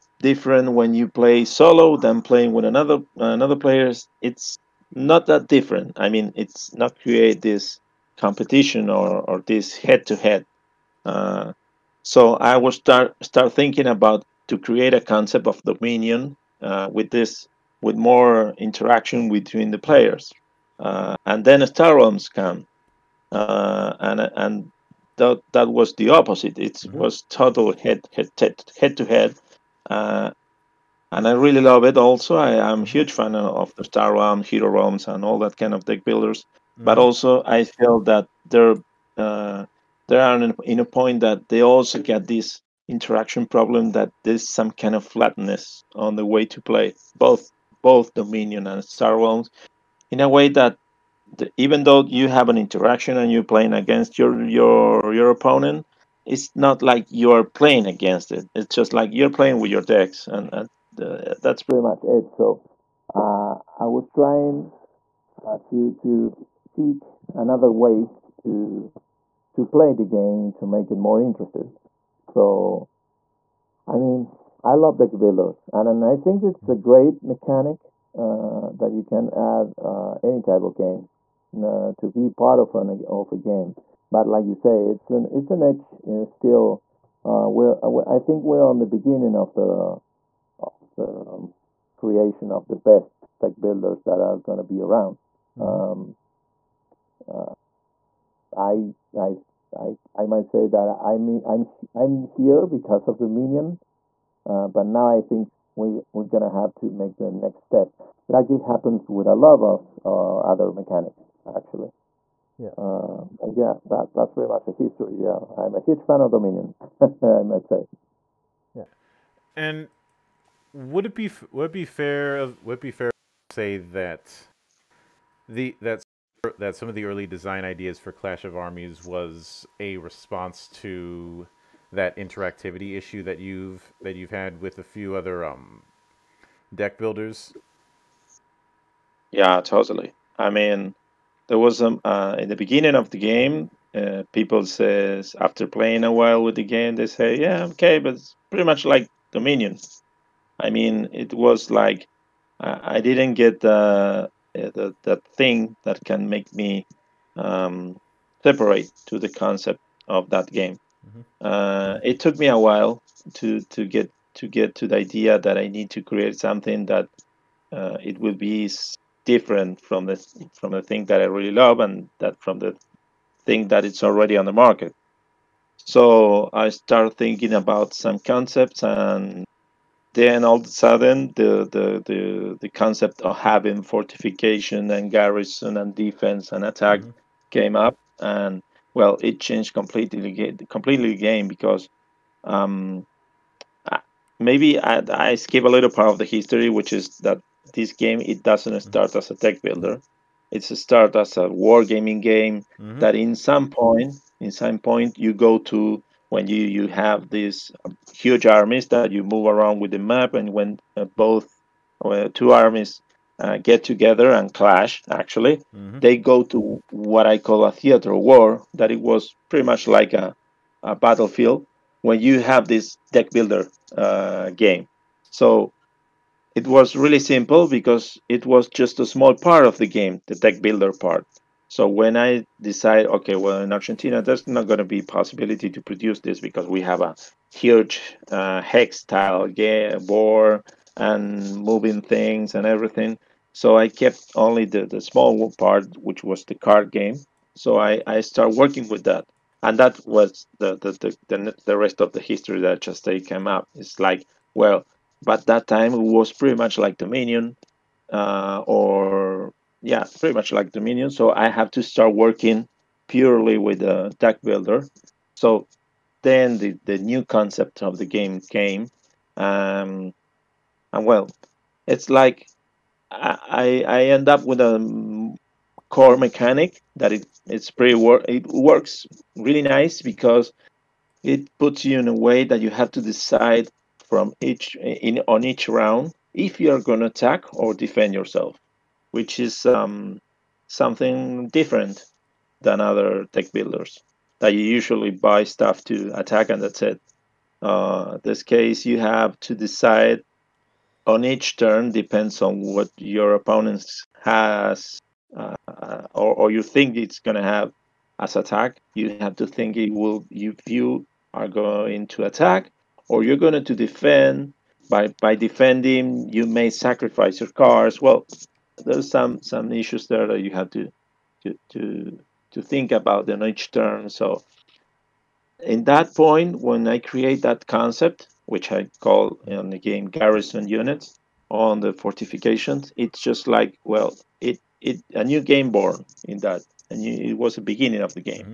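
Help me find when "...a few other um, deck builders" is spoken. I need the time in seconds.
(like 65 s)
134 s.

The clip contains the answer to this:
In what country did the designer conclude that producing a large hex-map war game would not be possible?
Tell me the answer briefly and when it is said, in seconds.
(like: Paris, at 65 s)
Argentina, at 233 s.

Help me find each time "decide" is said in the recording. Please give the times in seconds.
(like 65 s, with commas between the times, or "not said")
232 s, 283 s, 299 s.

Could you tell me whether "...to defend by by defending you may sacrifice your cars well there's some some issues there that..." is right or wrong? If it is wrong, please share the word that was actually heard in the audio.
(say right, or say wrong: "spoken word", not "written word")
right.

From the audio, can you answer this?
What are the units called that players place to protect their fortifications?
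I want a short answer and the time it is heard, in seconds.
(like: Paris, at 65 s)
garrison units, at 330 s.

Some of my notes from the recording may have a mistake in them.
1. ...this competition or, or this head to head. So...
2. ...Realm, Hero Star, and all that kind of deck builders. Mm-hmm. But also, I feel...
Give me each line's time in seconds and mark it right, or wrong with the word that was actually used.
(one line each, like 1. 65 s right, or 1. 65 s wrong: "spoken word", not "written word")
1. 7 s right
2. 34 s wrong: "Realms", not "Star".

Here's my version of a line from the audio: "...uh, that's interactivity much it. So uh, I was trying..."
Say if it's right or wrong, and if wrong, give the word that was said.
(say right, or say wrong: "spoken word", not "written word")
wrong: "pretty", not "interactivity".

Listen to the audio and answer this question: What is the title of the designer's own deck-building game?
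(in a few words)
Clash of Armies.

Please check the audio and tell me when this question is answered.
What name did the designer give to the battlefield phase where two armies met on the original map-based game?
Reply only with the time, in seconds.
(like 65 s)
217 s.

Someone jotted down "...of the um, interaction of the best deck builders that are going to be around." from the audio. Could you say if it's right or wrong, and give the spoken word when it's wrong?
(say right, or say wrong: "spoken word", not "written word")
wrong: "creation", not "interaction".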